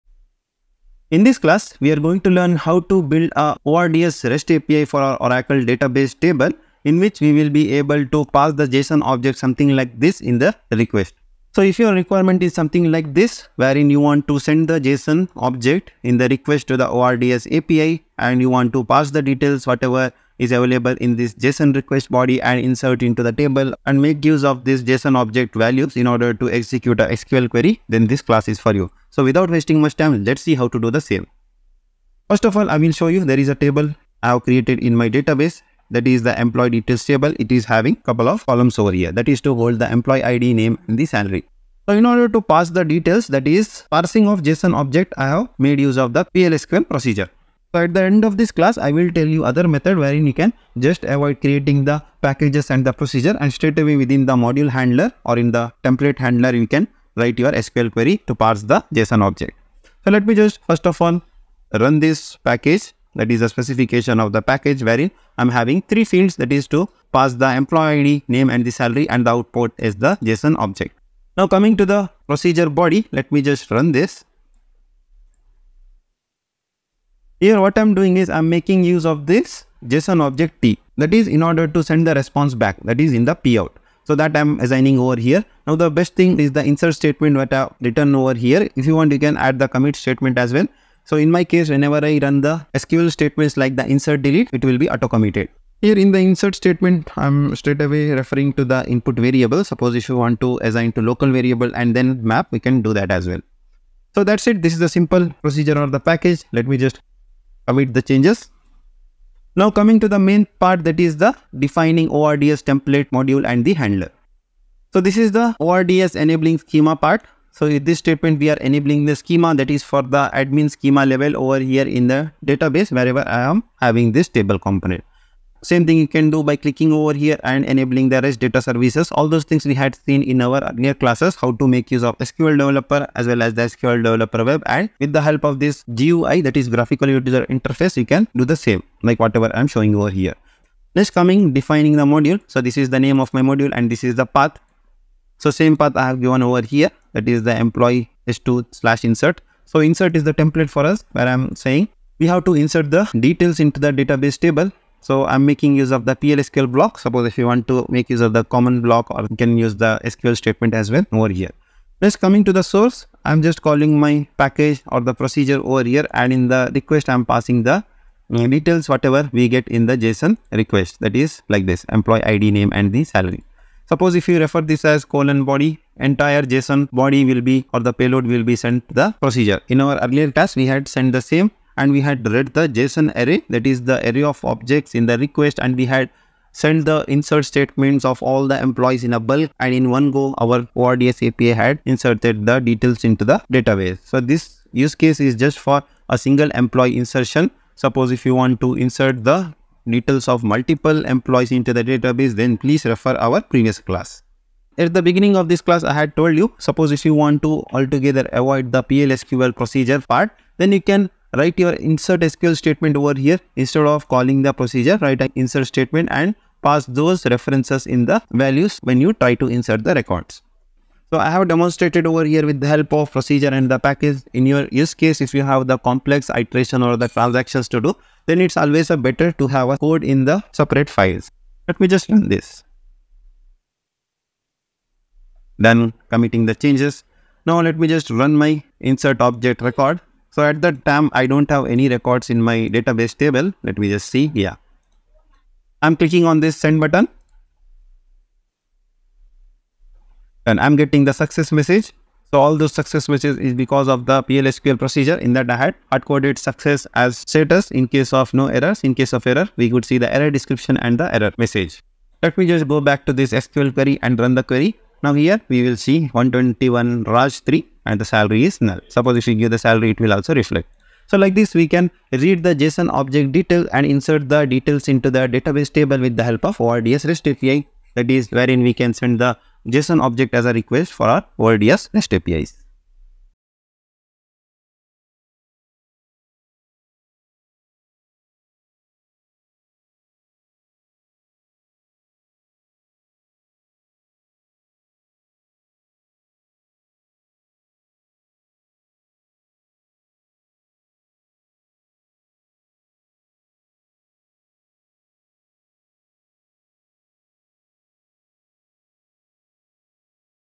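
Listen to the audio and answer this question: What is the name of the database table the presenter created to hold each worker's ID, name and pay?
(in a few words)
employee details.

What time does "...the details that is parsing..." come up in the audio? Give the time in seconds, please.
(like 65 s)
42 s.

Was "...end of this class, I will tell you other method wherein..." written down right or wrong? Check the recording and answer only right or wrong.
right.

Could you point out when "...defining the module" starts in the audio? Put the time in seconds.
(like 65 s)
141 s.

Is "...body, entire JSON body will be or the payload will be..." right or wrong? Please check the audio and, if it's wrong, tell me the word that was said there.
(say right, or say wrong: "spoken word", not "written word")
right.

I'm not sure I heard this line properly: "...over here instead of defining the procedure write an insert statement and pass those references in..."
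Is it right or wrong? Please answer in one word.
wrong.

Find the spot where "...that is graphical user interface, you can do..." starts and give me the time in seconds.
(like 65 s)
136 s.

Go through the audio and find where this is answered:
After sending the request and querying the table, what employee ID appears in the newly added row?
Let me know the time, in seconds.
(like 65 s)
266 s.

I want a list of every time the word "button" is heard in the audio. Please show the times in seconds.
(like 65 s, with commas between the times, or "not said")
246 s.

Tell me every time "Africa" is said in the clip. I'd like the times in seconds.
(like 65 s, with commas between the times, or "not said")
not said.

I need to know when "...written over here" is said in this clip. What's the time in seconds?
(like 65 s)
87 s.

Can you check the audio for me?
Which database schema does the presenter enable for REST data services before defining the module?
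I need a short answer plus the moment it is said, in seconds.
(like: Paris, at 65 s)
admin, at 120 s.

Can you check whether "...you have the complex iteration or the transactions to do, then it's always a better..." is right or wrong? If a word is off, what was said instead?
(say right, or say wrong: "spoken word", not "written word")
right.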